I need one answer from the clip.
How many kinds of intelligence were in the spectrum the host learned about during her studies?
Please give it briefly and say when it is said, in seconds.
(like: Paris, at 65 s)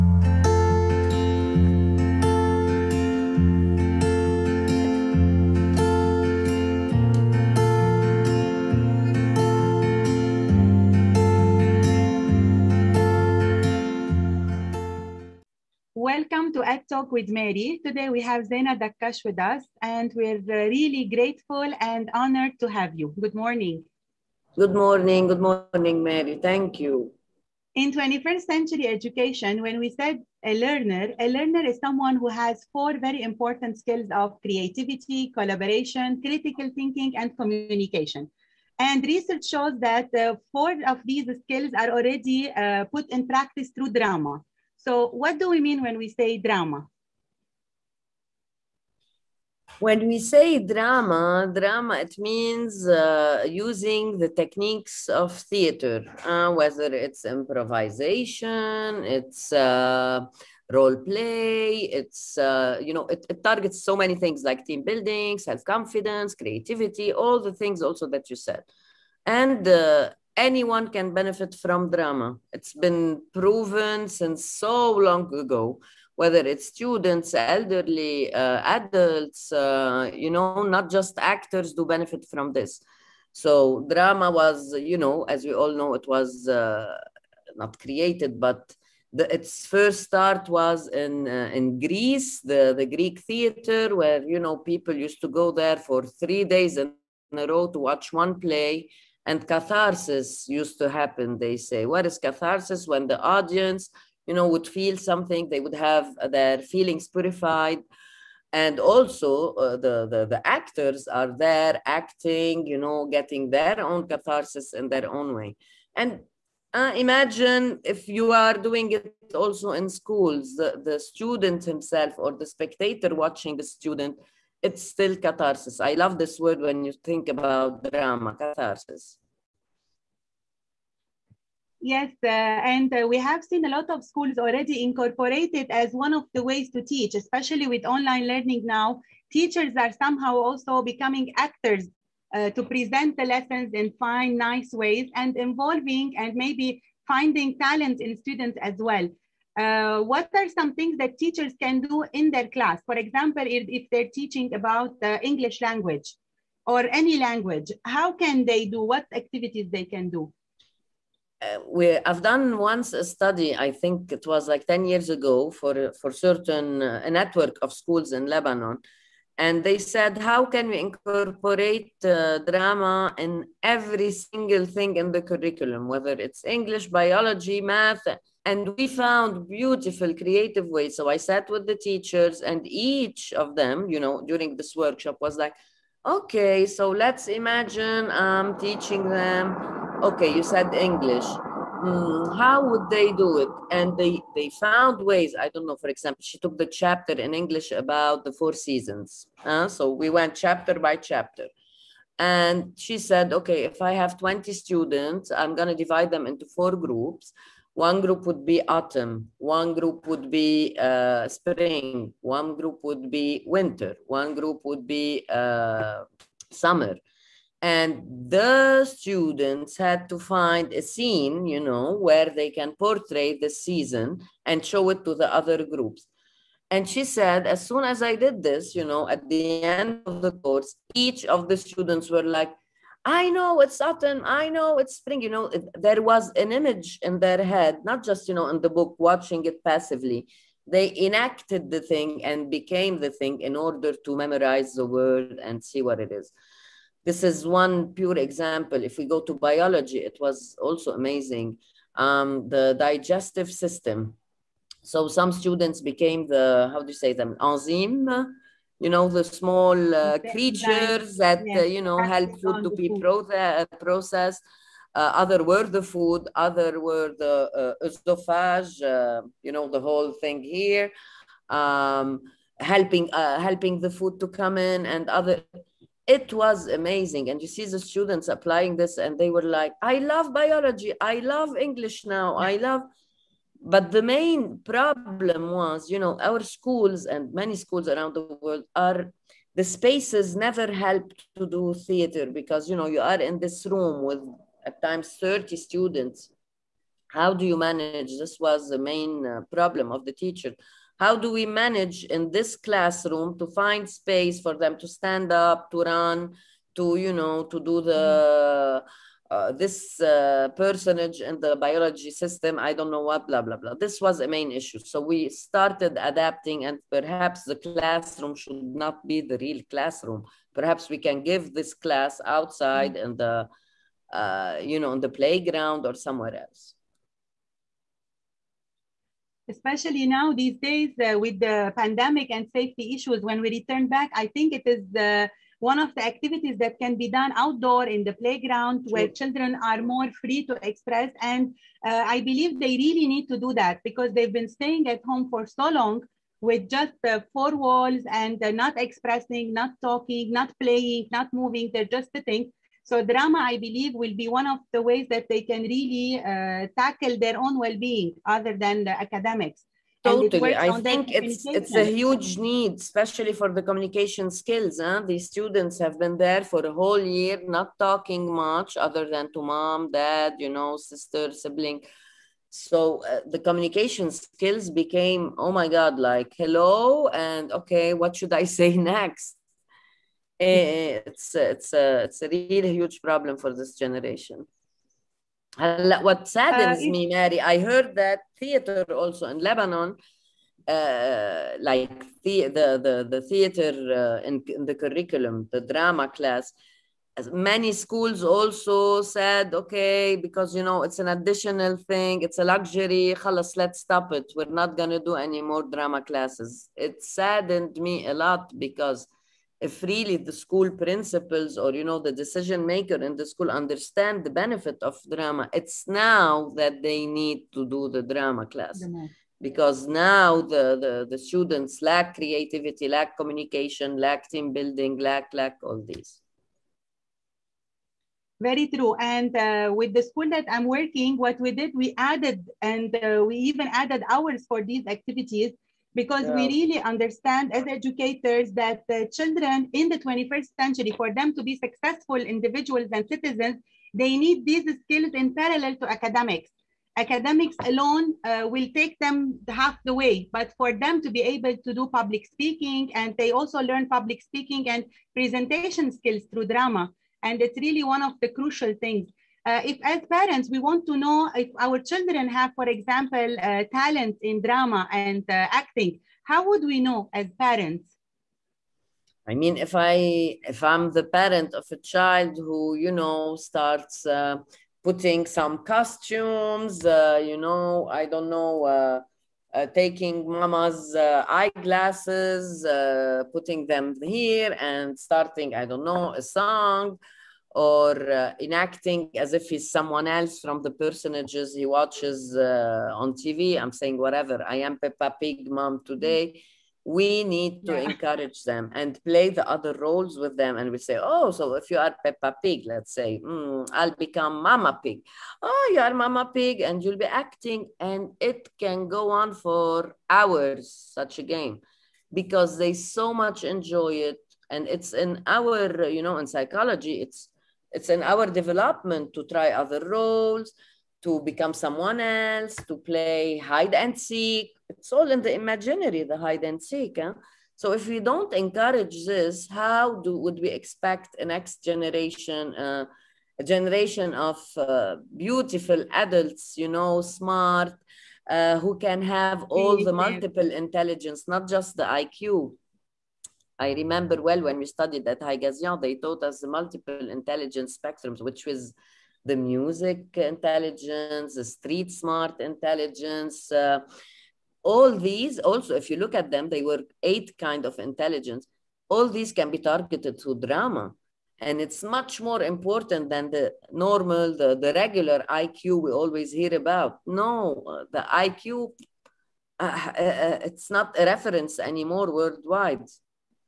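8, at 557 s.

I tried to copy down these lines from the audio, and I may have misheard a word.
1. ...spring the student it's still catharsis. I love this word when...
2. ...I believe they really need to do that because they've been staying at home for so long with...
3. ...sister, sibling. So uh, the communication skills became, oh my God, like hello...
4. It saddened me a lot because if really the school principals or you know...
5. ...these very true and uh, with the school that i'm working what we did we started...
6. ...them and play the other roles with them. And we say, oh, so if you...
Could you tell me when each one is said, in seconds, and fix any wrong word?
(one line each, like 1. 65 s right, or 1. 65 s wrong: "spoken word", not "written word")
1. 123 s wrong: "watching", not "spring"
2. 342 s right
3. 370 s right
4. 406 s right
5. 425 s wrong: "added", not "started"
6. 498 s right.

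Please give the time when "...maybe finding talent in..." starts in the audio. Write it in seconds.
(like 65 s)
146 s.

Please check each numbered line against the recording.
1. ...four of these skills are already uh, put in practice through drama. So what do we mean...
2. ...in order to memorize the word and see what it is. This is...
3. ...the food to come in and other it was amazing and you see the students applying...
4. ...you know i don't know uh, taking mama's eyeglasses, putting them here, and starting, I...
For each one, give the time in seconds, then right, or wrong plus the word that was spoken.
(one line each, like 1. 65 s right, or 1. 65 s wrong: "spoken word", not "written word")
1. 40 s right
2. 243 s right
3. 273 s right
4. 477 s right.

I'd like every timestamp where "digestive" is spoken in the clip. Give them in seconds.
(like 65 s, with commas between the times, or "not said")
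252 s.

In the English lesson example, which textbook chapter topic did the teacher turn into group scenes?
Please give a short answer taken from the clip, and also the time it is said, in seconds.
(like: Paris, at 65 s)
the four seasons, at 198 s.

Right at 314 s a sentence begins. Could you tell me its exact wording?
So we started adapting, and perhaps the classroom should not be the real classroom.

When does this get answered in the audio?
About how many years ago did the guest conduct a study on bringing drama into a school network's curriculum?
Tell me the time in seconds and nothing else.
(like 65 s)
164 s.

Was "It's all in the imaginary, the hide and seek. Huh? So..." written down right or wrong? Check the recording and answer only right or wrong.
right.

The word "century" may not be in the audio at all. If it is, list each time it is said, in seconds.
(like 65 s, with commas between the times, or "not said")
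28 s, 440 s.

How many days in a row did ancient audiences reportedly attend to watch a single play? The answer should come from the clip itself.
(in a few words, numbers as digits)
3.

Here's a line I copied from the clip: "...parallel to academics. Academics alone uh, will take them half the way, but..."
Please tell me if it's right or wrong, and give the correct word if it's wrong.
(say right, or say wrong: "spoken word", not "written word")
right.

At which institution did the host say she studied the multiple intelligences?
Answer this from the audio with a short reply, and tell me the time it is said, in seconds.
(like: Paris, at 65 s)
Haigazian, at 545 s.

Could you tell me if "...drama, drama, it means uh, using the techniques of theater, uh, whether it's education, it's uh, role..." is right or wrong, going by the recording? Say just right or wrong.
wrong.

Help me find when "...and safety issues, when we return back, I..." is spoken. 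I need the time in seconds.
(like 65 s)
332 s.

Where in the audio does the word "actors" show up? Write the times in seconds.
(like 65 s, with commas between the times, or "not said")
81 s, 110 s, 141 s.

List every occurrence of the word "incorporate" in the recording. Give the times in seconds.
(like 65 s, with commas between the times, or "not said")
134 s, 170 s.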